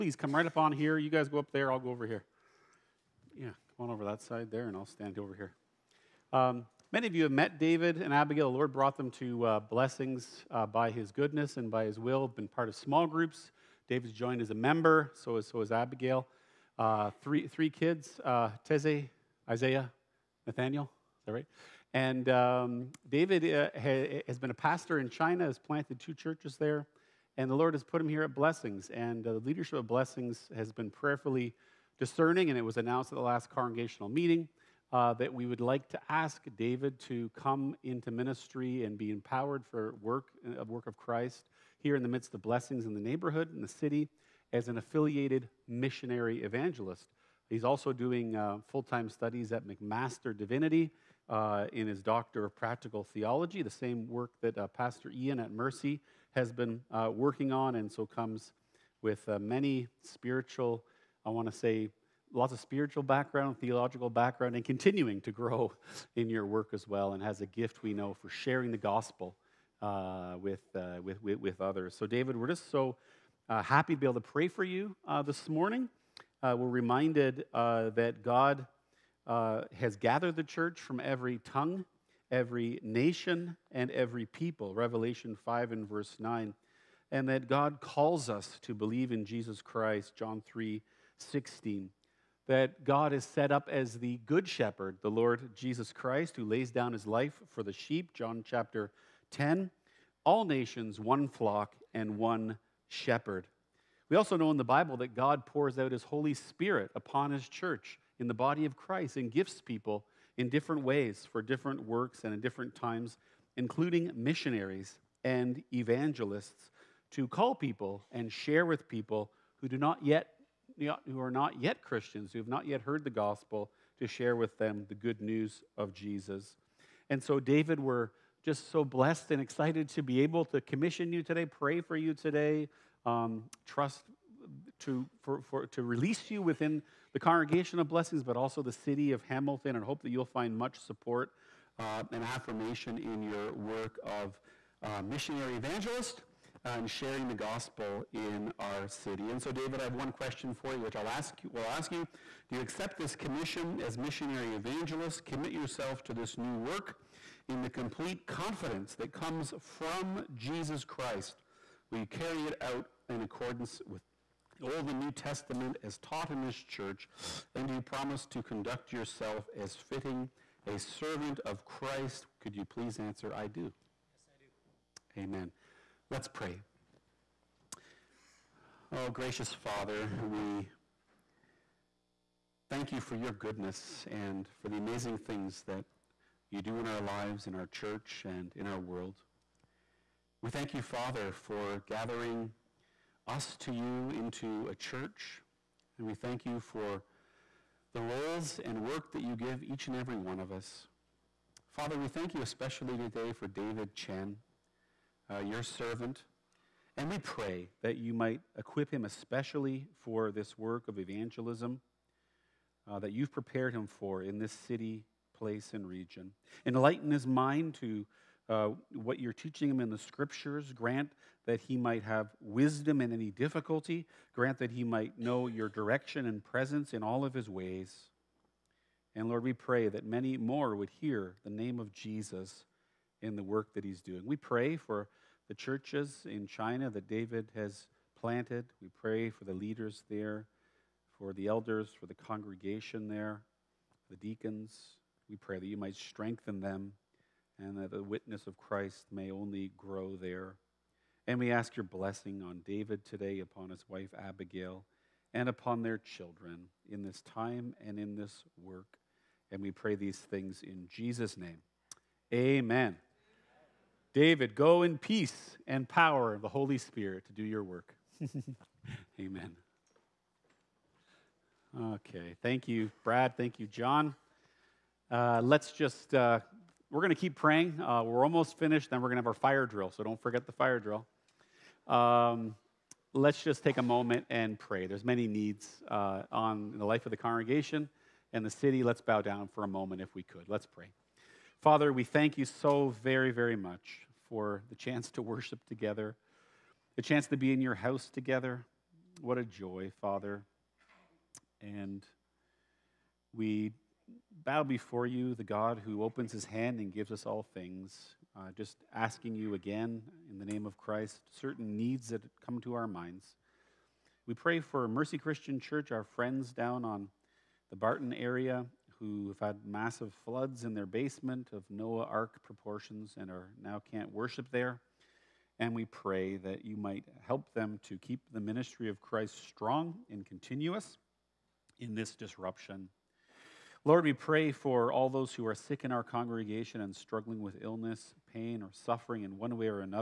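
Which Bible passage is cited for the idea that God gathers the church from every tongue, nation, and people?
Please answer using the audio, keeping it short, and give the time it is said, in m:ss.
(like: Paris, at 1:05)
Revelation 5:9, at 1:24.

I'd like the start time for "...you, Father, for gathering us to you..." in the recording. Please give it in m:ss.
3:10.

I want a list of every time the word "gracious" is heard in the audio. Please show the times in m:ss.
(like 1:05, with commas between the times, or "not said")
2:59.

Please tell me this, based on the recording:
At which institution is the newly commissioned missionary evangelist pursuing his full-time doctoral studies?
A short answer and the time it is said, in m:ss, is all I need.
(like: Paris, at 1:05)
McMaster Divinity, at 0:49.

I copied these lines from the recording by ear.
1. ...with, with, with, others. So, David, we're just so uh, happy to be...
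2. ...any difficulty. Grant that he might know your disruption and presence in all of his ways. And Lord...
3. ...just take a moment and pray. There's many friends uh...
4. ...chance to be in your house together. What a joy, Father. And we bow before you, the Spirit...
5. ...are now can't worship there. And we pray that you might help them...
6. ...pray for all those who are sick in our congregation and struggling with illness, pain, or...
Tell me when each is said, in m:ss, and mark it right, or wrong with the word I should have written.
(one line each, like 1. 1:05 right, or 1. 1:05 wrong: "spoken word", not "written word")
1. 1:11 right
2. 3:43 wrong: "direction", not "disruption"
3. 4:43 wrong: "needs", not "friends"
4. 4:57 wrong: "God", not "Spirit"
5. 5:23 right
6. 5:34 right.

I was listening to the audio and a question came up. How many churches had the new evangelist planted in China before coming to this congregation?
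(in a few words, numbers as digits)
2.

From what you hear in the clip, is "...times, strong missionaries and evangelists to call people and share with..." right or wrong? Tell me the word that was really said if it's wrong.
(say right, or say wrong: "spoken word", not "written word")
wrong: "including", not "strong".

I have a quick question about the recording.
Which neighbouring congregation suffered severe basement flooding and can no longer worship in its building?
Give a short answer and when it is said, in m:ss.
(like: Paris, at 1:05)
Mercy Christian Church, at 5:14.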